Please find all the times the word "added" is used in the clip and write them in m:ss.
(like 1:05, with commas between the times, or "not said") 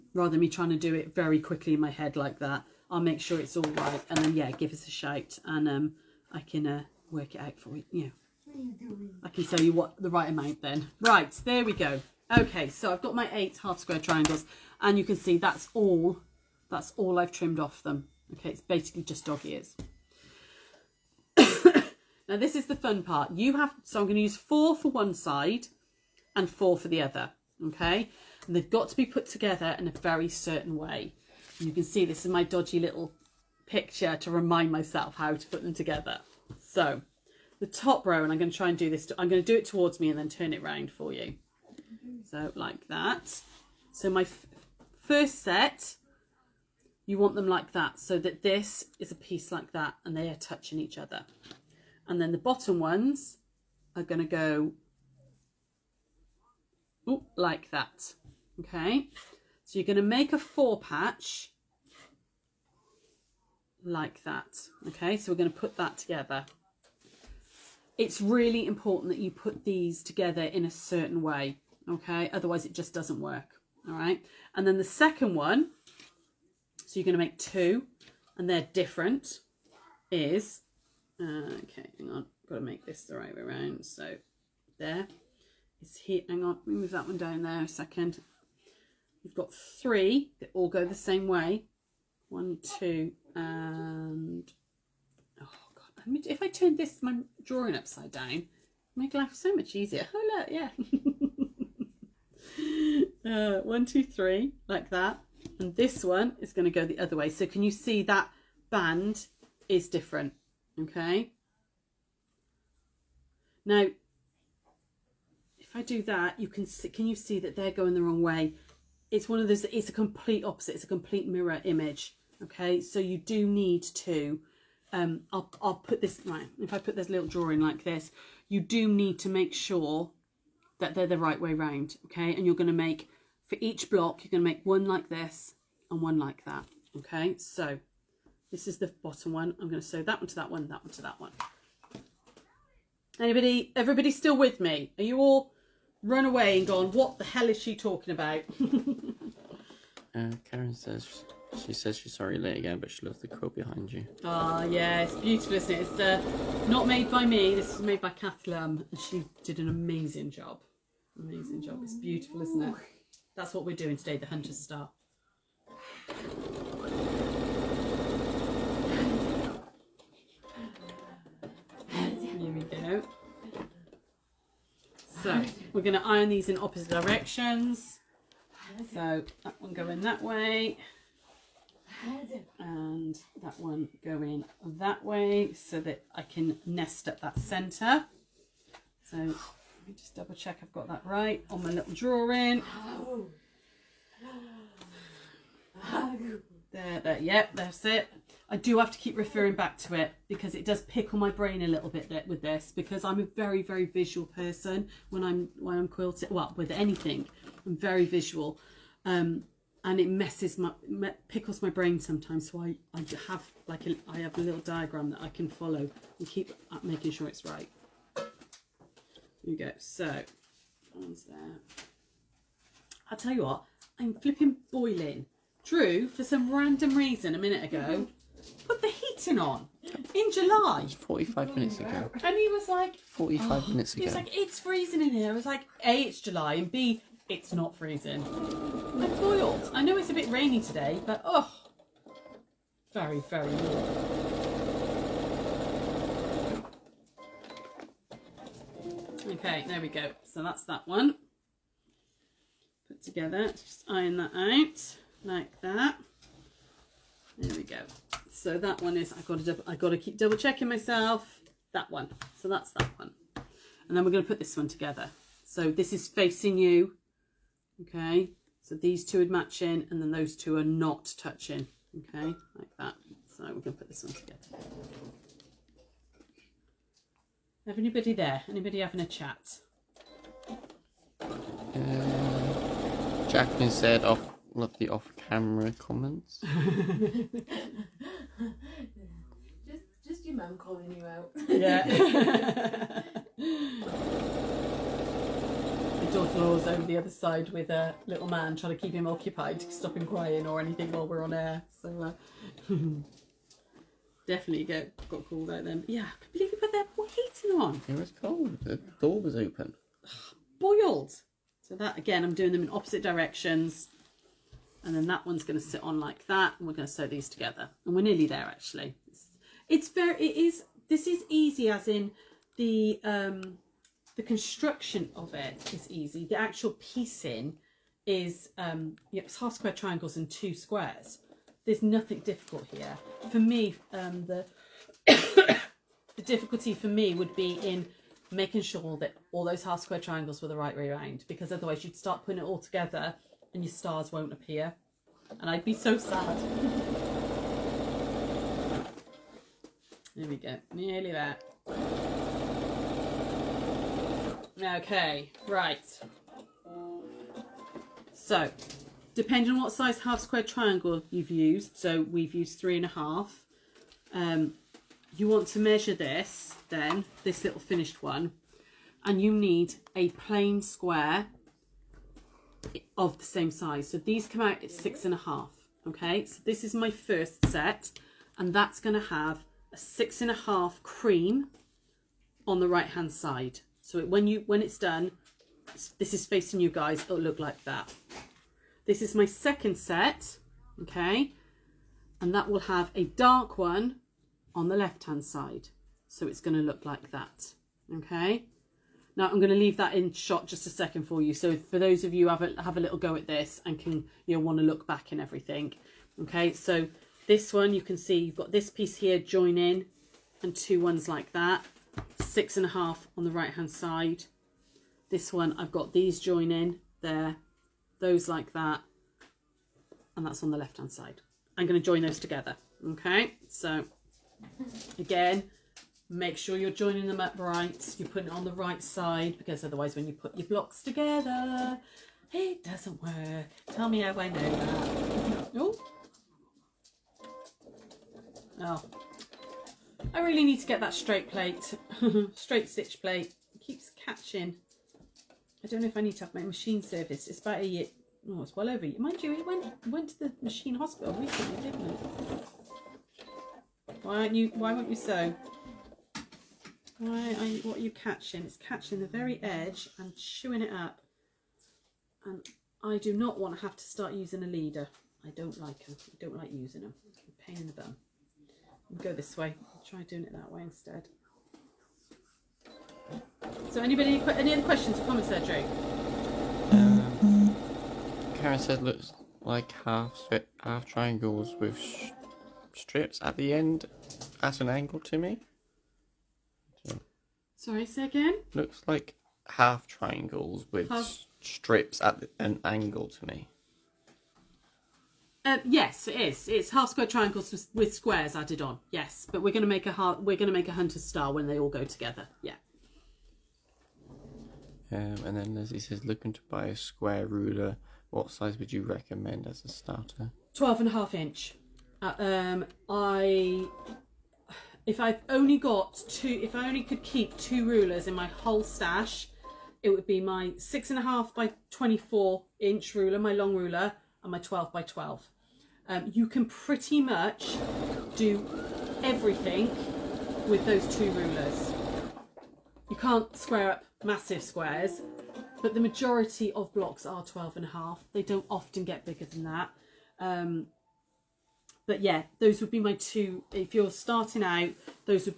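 8:18.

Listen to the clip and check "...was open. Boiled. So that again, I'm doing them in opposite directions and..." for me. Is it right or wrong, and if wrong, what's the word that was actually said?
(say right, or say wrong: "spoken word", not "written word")
right.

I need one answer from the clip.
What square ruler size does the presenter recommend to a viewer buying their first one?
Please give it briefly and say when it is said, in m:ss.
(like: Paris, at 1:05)
12.5 inch, at 8:30.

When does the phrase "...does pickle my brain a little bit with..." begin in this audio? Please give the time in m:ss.
3:20.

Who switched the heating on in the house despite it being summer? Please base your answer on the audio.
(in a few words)
Drew.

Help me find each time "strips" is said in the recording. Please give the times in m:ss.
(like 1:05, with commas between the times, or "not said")
8:02, 8:11.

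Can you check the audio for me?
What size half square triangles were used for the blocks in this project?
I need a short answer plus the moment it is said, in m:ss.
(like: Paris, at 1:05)
3.5 inches, at 6:02.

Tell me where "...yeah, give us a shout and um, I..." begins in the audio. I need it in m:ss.
0:04.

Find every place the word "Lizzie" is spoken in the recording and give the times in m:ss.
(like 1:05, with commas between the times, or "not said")
8:25.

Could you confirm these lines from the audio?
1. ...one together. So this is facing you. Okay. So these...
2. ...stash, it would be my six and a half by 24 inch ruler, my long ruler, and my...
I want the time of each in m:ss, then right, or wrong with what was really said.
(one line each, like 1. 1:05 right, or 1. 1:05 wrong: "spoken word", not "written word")
1. 4:24 right
2. 8:38 right.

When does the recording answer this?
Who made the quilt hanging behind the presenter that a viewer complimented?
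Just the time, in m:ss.
2:38.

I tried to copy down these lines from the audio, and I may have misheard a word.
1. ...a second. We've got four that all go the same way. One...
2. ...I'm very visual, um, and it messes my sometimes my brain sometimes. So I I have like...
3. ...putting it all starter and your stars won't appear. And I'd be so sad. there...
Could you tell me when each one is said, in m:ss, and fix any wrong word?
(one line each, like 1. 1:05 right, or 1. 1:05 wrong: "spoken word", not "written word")
1. 1:27 wrong: "three", not "four"
2. 3:27 wrong: "pickles", not "sometimes"
3. 5:42 wrong: "together", not "starter".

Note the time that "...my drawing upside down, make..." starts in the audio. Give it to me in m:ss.
1:37.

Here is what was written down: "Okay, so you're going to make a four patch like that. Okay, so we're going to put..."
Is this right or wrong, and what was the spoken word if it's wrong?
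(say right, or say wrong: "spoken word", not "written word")
right.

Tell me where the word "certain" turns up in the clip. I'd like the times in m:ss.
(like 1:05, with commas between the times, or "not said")
0:30, 1:10.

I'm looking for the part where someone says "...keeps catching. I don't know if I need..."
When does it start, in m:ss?
7:23.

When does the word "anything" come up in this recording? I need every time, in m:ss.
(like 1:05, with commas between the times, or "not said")
3:26, 5:00.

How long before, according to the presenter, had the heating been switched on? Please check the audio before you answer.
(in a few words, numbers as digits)
45 minutes.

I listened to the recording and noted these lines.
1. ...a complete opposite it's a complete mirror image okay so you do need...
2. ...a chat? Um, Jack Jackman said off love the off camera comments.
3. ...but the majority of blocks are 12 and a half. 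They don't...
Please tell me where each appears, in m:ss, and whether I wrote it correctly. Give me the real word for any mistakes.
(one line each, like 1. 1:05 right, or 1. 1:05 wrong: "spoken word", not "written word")
1. 1:59 right
2. 4:38 right
3. 8:55 right.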